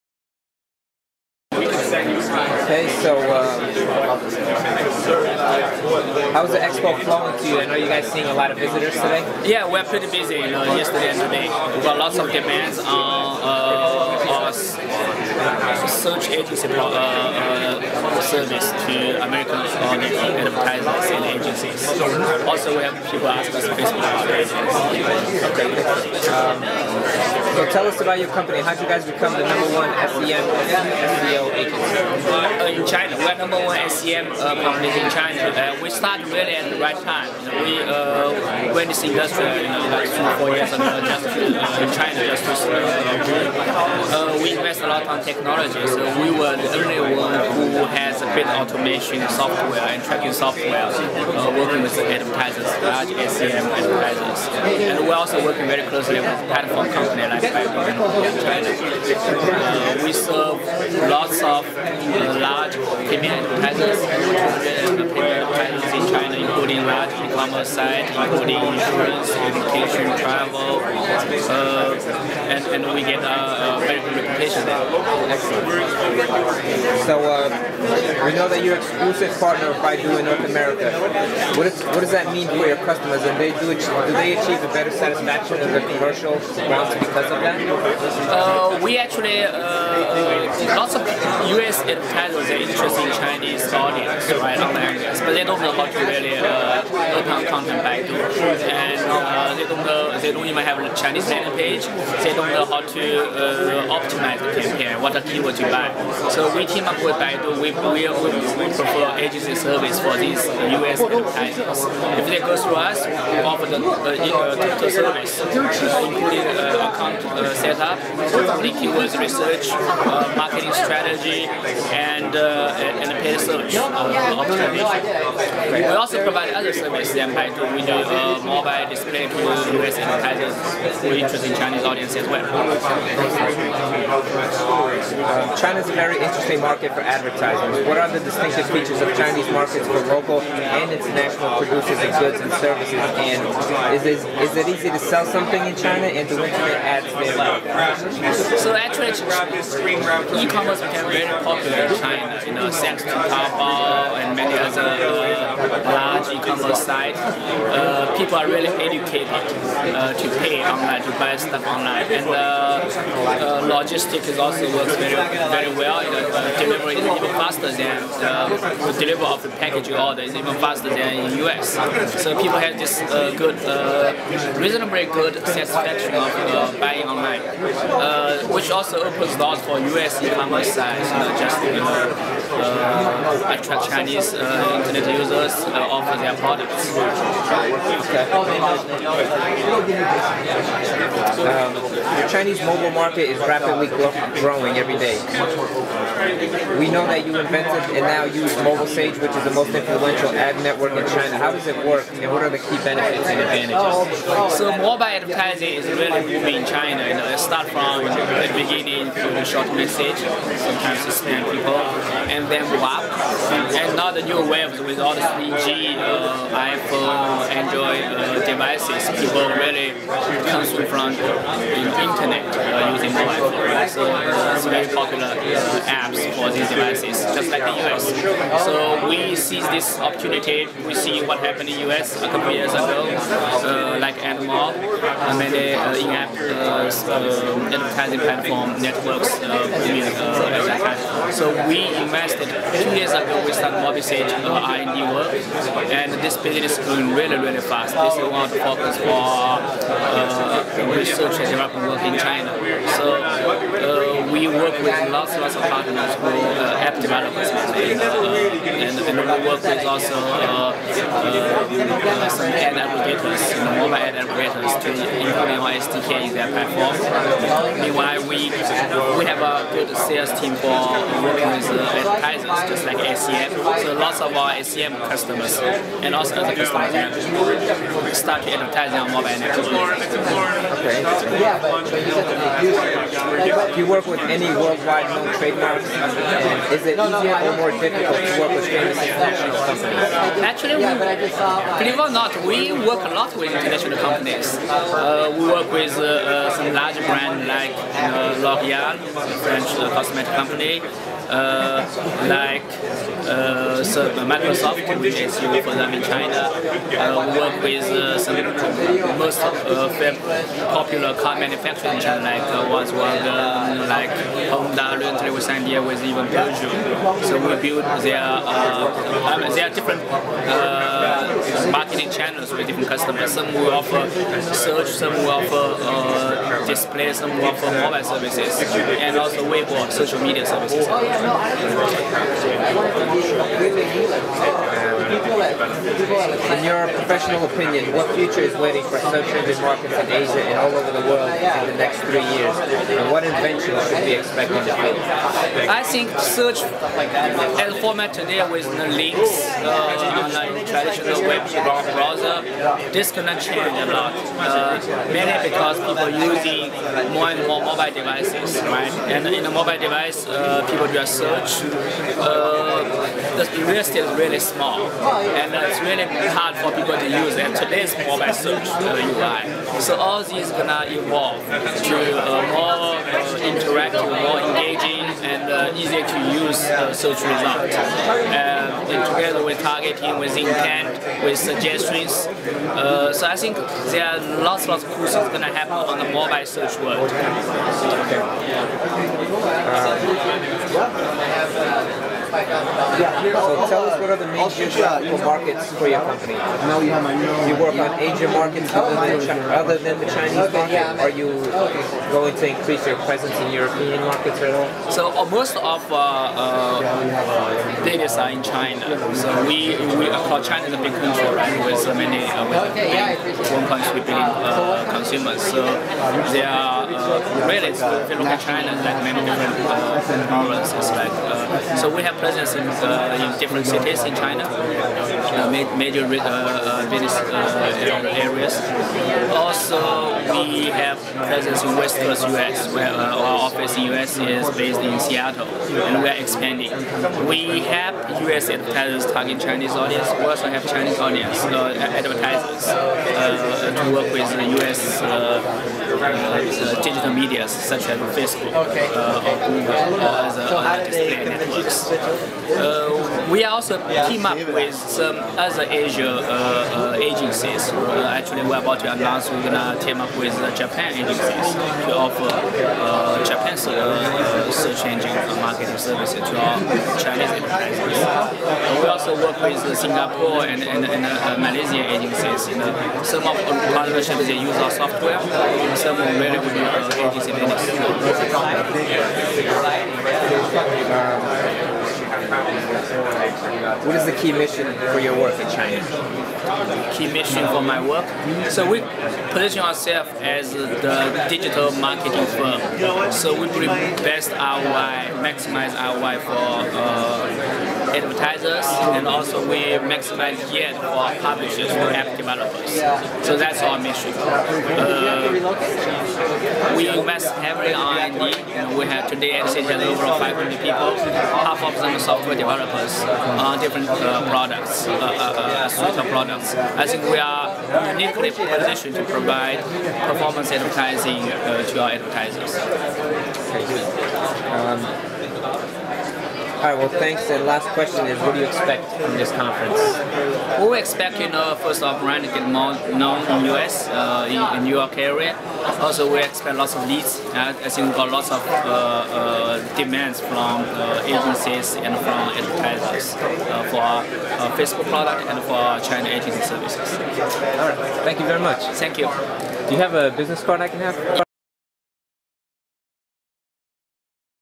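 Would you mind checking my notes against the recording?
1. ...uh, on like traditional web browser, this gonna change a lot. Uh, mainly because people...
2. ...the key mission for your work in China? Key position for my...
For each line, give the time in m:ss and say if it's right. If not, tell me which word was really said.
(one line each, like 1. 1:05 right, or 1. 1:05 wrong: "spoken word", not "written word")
1. 5:49 right
2. 8:04 wrong: "mission", not "position".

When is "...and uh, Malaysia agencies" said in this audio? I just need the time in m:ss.
7:50.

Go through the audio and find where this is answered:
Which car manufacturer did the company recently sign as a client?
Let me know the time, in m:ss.
5:16.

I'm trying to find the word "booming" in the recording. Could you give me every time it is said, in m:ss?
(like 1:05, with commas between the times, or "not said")
3:26.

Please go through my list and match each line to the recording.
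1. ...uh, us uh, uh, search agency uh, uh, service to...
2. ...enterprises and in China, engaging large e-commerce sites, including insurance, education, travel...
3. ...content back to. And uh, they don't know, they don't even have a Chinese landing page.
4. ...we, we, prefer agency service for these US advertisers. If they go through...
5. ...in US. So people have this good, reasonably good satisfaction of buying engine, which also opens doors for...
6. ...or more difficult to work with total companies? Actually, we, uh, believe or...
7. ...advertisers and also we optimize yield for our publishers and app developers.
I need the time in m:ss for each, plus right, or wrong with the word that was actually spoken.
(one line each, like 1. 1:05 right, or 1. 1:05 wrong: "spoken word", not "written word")
1. 0:13 right
2. 1:03 wrong: "including", not "engaging"
3. 1:37 right
4. 1:47 right
5. 2:51 wrong: "online", not "engine"
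6. 4:47 wrong: "international", not "total"
7. 8:17 wrong: "maximize", not "optimize".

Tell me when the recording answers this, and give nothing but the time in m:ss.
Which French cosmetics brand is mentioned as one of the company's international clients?
4:58.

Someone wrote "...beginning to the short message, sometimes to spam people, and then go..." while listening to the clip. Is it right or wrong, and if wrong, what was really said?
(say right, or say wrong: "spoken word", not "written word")
right.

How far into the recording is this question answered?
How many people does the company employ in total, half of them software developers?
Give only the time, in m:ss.
8:29.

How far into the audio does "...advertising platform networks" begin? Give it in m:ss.
3:57.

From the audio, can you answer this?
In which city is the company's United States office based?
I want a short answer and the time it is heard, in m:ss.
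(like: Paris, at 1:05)
Seattle, at 7:14.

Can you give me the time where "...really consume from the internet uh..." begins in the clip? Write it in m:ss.
3:39.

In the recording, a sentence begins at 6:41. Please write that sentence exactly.
Are you going to increase your presence in European markets at all?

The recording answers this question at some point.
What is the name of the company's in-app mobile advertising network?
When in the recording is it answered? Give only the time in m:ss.
4:03.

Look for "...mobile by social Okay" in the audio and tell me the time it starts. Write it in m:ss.
6:26.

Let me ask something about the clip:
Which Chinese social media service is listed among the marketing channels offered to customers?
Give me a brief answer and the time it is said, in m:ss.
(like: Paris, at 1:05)
Weibo, at 5:29.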